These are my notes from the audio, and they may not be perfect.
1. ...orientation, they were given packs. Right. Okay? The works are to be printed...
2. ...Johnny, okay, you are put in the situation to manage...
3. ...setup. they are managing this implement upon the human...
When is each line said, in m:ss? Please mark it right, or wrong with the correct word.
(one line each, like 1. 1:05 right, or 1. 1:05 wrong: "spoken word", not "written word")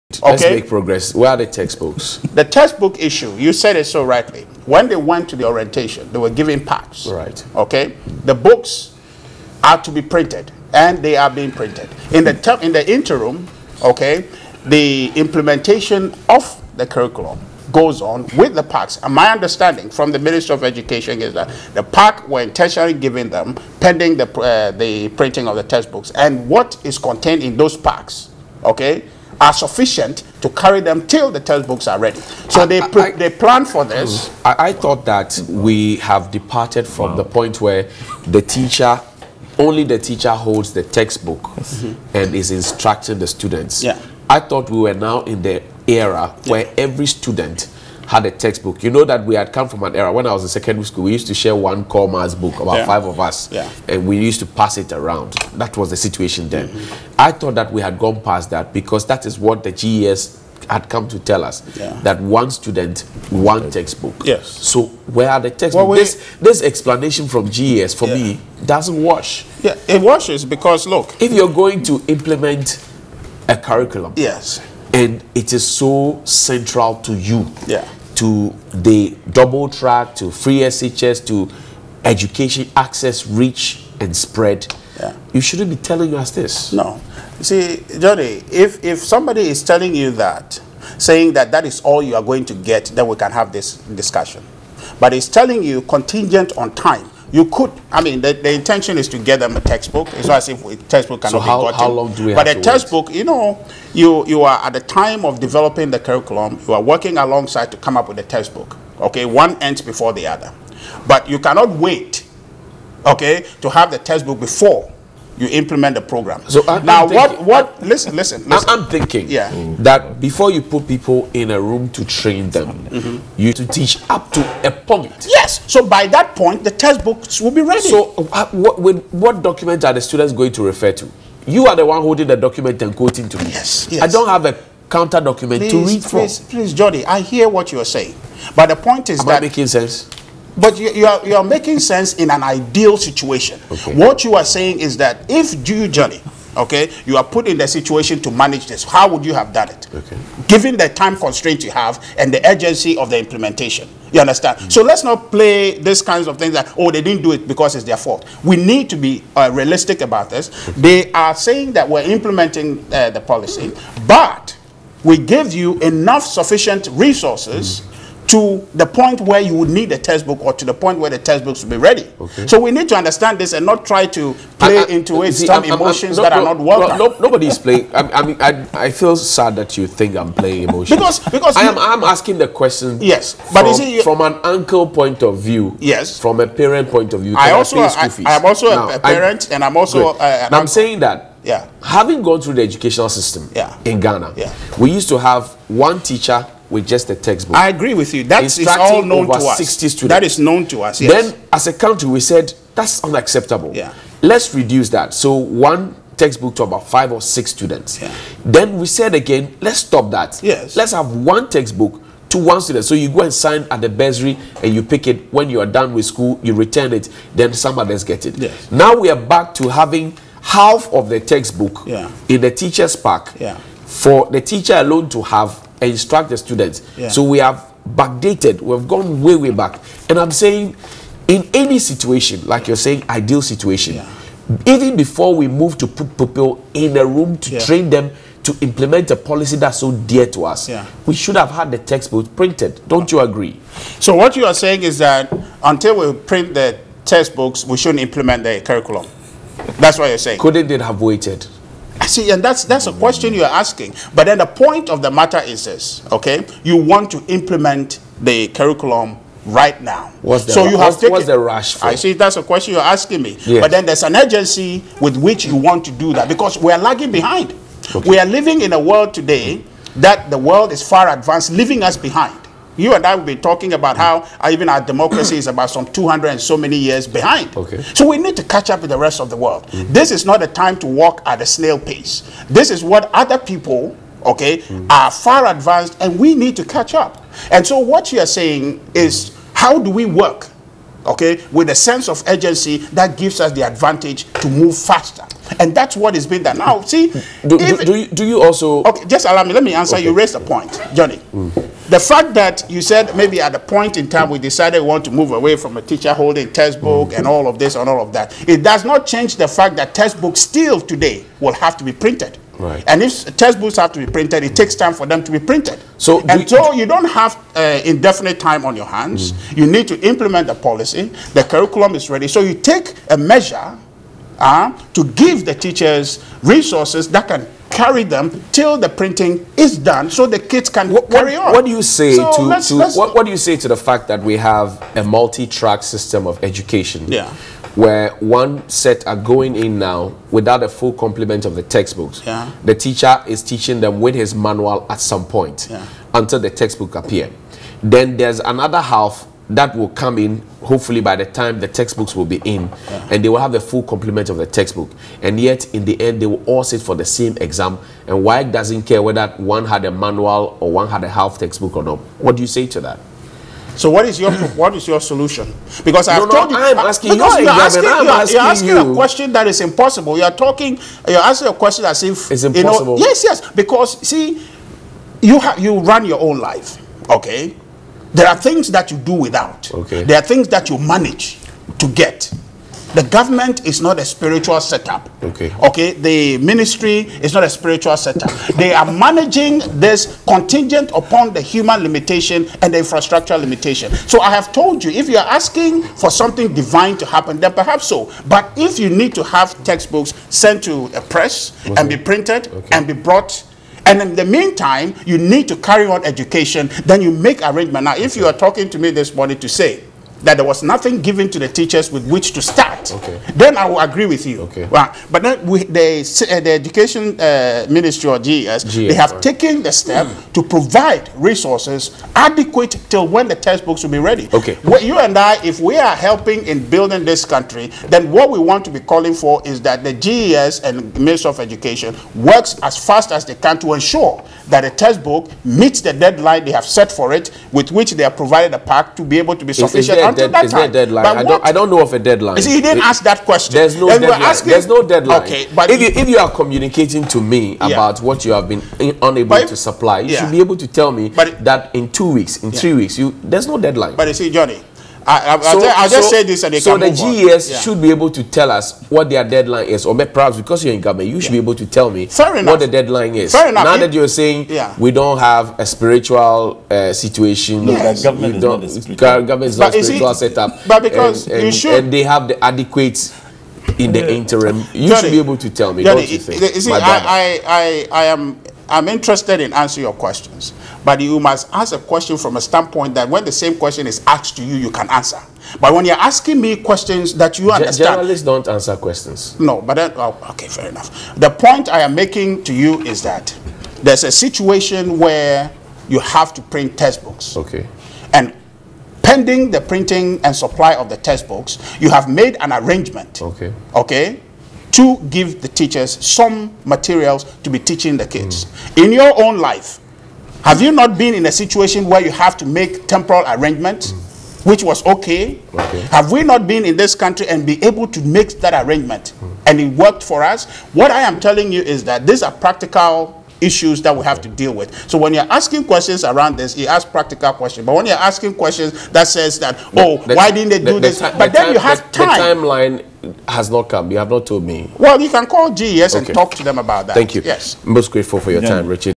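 1. 0:05 wrong: "books", not "works"
2. 2:25 right
3. 6:27 wrong: "contingent", not "implement".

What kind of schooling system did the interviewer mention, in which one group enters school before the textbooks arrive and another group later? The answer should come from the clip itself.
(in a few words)
multi-track system.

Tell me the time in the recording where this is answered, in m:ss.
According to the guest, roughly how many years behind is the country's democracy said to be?
4:35.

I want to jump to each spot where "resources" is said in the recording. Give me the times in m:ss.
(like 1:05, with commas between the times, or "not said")
2:46, 5:26, 7:01.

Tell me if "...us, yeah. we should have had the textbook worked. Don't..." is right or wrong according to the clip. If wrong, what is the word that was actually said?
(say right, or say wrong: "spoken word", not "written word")
wrong: "printed", not "worked".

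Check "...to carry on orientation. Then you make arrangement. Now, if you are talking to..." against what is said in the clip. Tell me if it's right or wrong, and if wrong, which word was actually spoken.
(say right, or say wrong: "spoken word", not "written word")
wrong: "education", not "orientation".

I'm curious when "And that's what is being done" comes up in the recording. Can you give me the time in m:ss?
4:55.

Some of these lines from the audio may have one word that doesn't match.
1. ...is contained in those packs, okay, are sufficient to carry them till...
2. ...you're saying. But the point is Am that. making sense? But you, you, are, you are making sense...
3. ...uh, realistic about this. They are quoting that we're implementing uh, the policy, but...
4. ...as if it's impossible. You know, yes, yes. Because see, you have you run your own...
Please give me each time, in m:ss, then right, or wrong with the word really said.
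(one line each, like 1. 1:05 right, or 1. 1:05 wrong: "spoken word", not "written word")
1. 0:26 right
2. 2:17 right
3. 2:39 wrong: "saying", not "quoting"
4. 6:11 right.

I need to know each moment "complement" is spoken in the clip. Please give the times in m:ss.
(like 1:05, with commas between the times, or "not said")
5:40, 5:53.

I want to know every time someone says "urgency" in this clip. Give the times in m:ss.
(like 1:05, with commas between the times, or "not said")
2:32, 4:24, 4:52.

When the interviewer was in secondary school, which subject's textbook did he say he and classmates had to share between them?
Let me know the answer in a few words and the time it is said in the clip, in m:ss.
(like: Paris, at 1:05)
core maths, at 0:51.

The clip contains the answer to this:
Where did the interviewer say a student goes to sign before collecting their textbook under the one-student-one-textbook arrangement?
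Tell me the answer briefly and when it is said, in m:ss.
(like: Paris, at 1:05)
the bursary, at 3:33.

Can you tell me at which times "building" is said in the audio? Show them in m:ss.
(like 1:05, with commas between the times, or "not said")
7:06.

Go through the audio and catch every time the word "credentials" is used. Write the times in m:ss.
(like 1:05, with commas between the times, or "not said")
not said.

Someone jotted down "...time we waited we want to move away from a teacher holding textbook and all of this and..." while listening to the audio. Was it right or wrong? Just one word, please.
wrong.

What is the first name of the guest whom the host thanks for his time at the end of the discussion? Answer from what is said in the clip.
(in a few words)
Richard.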